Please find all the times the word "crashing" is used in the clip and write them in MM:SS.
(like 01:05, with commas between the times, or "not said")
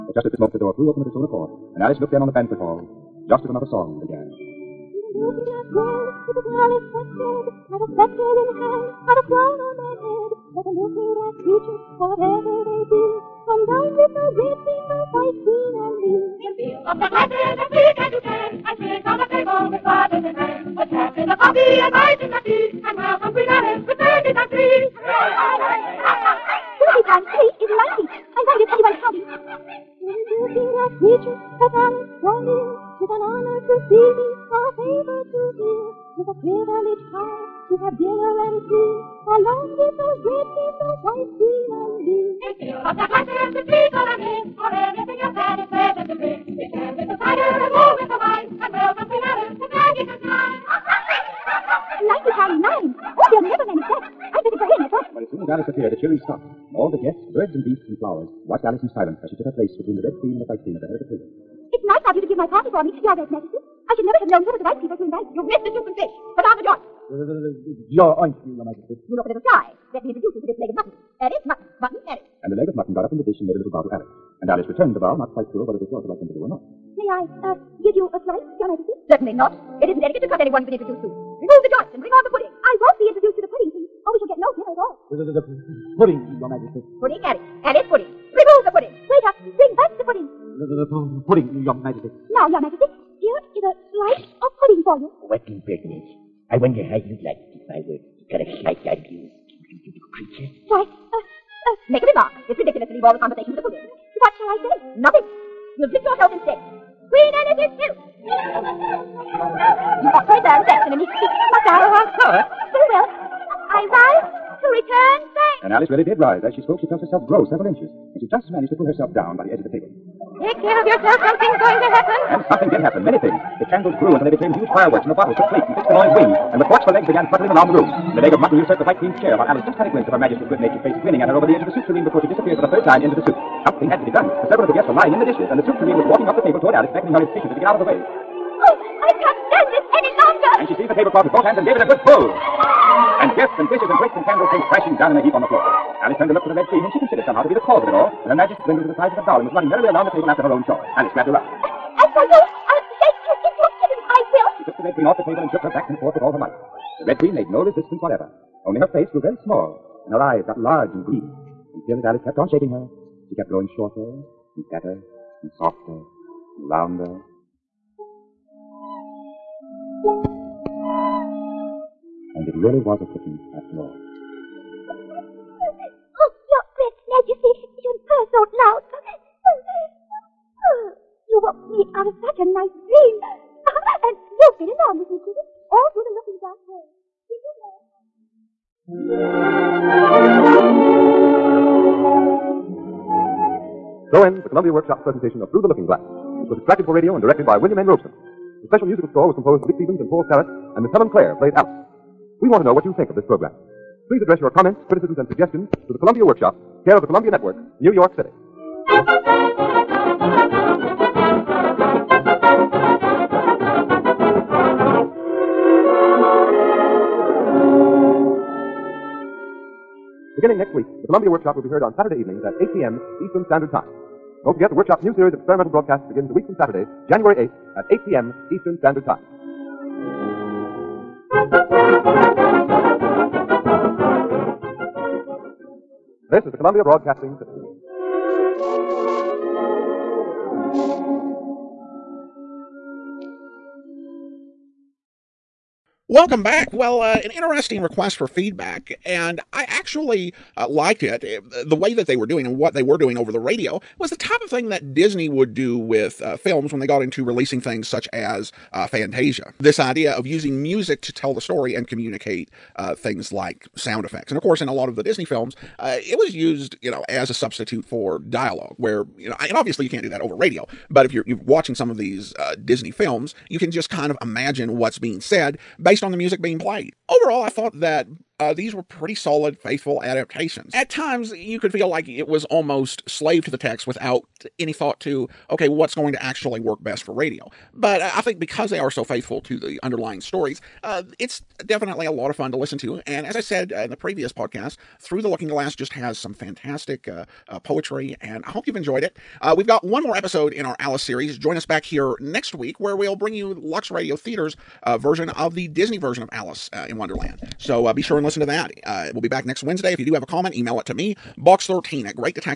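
02:24.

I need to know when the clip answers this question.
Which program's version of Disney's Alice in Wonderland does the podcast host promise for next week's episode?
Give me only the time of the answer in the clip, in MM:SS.
05:03.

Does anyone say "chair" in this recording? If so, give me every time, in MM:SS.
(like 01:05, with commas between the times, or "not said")
02:09.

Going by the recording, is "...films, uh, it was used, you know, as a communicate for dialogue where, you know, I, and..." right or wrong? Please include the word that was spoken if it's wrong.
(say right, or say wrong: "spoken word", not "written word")
wrong: "substitute", not "communicate".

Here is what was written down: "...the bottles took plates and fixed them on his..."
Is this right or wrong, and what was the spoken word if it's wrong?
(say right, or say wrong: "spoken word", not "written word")
right.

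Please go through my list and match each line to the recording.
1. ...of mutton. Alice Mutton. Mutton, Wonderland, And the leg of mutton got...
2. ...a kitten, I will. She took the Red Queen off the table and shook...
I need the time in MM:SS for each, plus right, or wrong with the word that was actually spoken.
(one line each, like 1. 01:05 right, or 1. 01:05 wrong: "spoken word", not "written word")
1. 01:10 wrong: "Alice", not "Wonderland"
2. 02:33 right.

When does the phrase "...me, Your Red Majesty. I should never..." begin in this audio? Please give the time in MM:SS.
01:02.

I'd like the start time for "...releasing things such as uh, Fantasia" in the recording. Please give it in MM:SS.
04:17.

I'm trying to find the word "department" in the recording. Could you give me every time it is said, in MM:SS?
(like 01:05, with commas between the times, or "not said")
not said.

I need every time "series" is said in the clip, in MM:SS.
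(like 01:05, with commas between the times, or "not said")
03:45, 05:01.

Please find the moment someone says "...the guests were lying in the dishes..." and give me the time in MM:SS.
02:14.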